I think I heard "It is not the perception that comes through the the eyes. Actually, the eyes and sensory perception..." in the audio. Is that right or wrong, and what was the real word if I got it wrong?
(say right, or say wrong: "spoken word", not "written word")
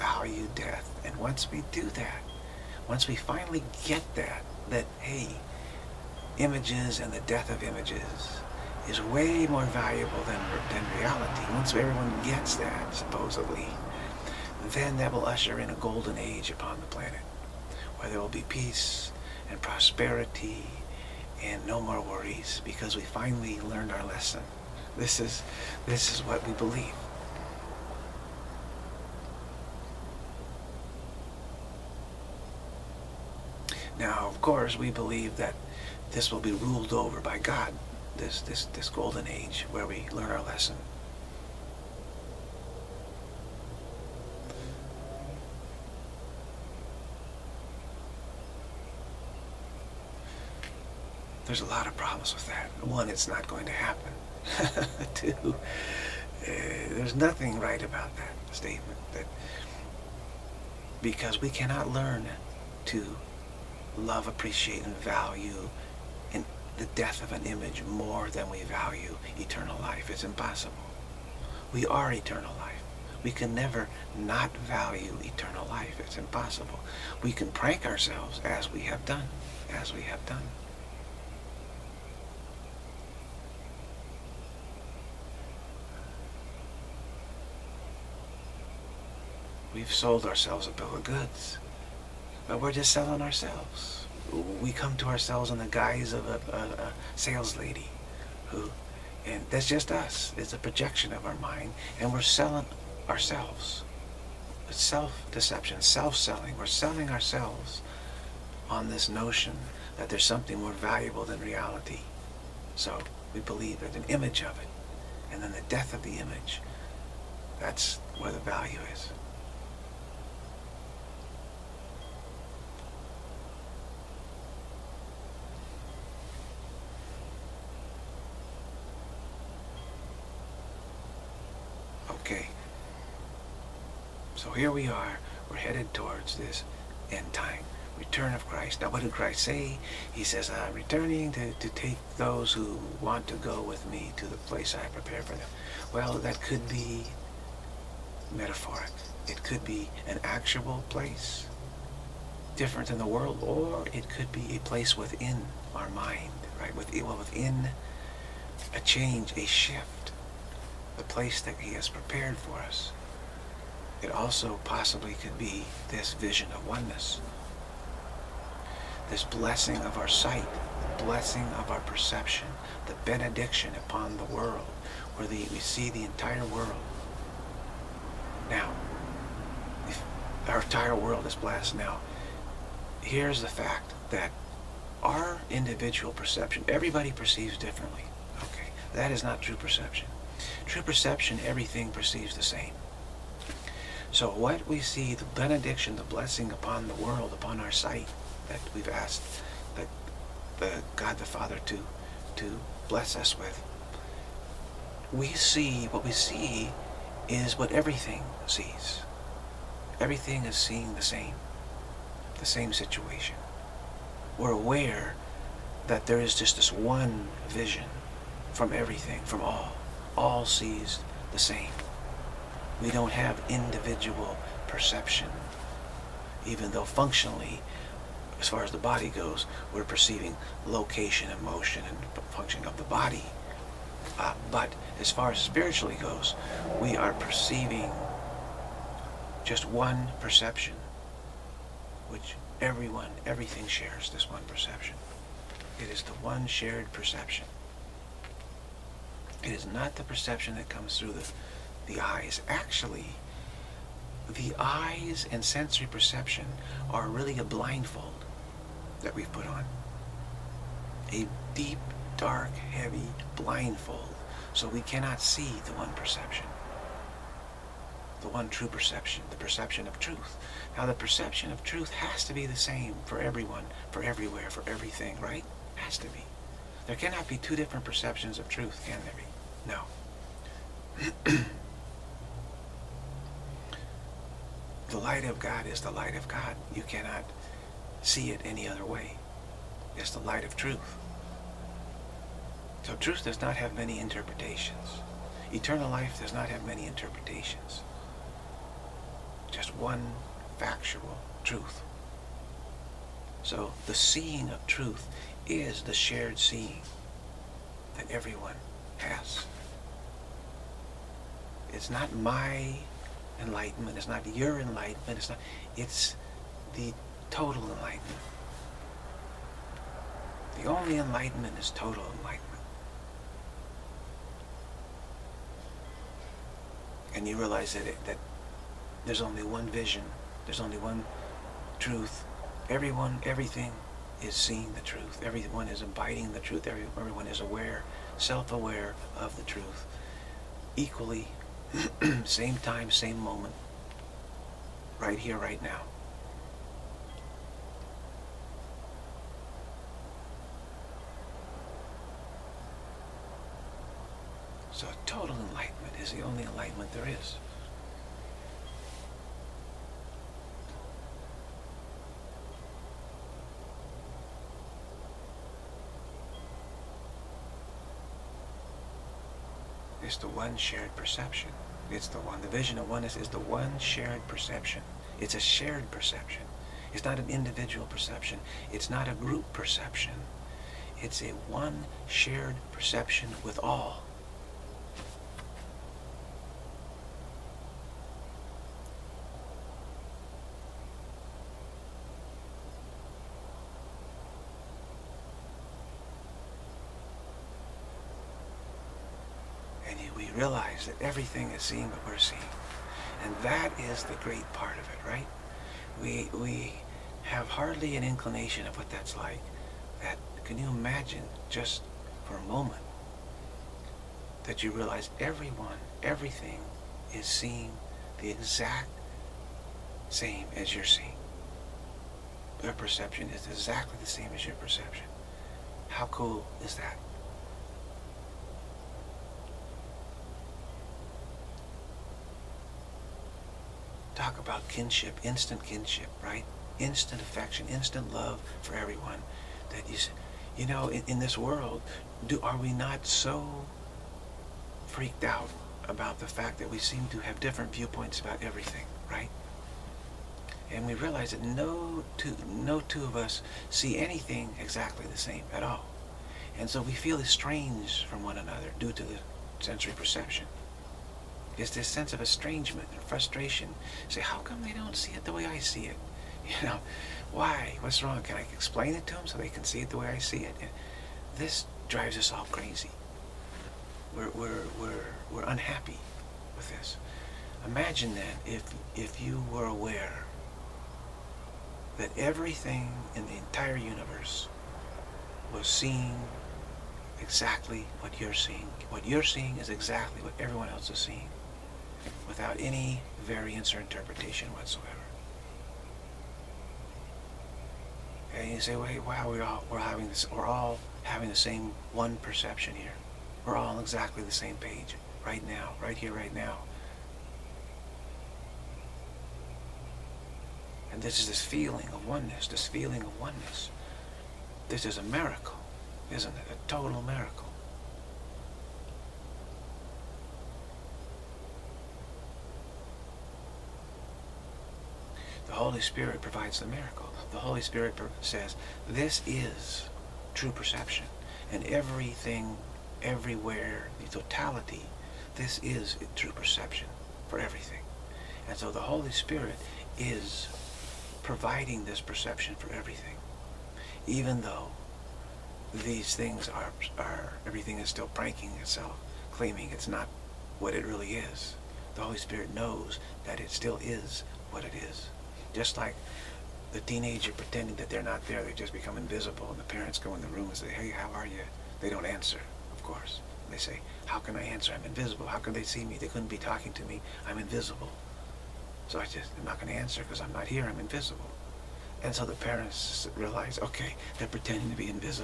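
right.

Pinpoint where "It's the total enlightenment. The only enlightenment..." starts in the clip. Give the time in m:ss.
5:15.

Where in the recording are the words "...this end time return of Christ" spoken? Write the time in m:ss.
2:16.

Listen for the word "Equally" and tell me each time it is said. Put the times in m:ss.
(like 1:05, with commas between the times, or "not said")
5:40.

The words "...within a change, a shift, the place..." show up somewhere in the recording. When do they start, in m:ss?
2:37.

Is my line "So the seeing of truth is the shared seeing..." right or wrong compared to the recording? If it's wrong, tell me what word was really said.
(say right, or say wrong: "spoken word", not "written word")
right.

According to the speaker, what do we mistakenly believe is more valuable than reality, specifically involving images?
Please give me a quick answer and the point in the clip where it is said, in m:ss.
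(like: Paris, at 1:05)
The death of images, at 0:07.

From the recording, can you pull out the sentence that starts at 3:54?
Uh, but as far as spiritually goes, we are perceiving just one perception, which everyone, everything shares this one perception.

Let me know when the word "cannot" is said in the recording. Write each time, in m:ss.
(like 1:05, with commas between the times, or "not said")
1:01, 4:24, 4:36, 4:46.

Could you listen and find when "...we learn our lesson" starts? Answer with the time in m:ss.
0:39.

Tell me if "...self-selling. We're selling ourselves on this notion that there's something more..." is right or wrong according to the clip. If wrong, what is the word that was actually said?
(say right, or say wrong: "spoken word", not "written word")
right.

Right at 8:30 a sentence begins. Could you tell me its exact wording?
And this is this feeling of oneness, this feeling of oneness.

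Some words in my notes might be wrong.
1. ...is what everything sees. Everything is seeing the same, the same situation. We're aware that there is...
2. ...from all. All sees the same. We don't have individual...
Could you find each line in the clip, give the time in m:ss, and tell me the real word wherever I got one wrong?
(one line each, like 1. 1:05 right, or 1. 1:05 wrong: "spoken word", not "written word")
1. 3:27 right
2. 3:39 right.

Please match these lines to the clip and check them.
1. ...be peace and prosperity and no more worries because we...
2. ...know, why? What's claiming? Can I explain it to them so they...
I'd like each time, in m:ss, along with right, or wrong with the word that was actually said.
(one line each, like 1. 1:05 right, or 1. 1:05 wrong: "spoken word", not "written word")
1. 0:18 right
2. 7:46 wrong: "wrong", not "claiming".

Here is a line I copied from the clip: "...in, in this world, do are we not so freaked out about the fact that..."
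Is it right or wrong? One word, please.
right.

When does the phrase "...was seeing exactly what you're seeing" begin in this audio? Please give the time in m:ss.
8:05.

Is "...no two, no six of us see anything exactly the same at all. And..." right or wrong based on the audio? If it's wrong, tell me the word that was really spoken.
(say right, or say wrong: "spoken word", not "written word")
wrong: "two", not "six".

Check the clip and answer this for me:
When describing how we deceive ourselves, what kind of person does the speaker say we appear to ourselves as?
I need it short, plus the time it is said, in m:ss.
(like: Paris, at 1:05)
A sales lady, at 1:37.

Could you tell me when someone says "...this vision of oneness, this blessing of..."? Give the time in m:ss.
2:45.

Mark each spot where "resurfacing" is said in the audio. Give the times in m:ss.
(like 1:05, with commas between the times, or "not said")
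not said.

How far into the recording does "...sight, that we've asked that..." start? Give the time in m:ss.
3:17.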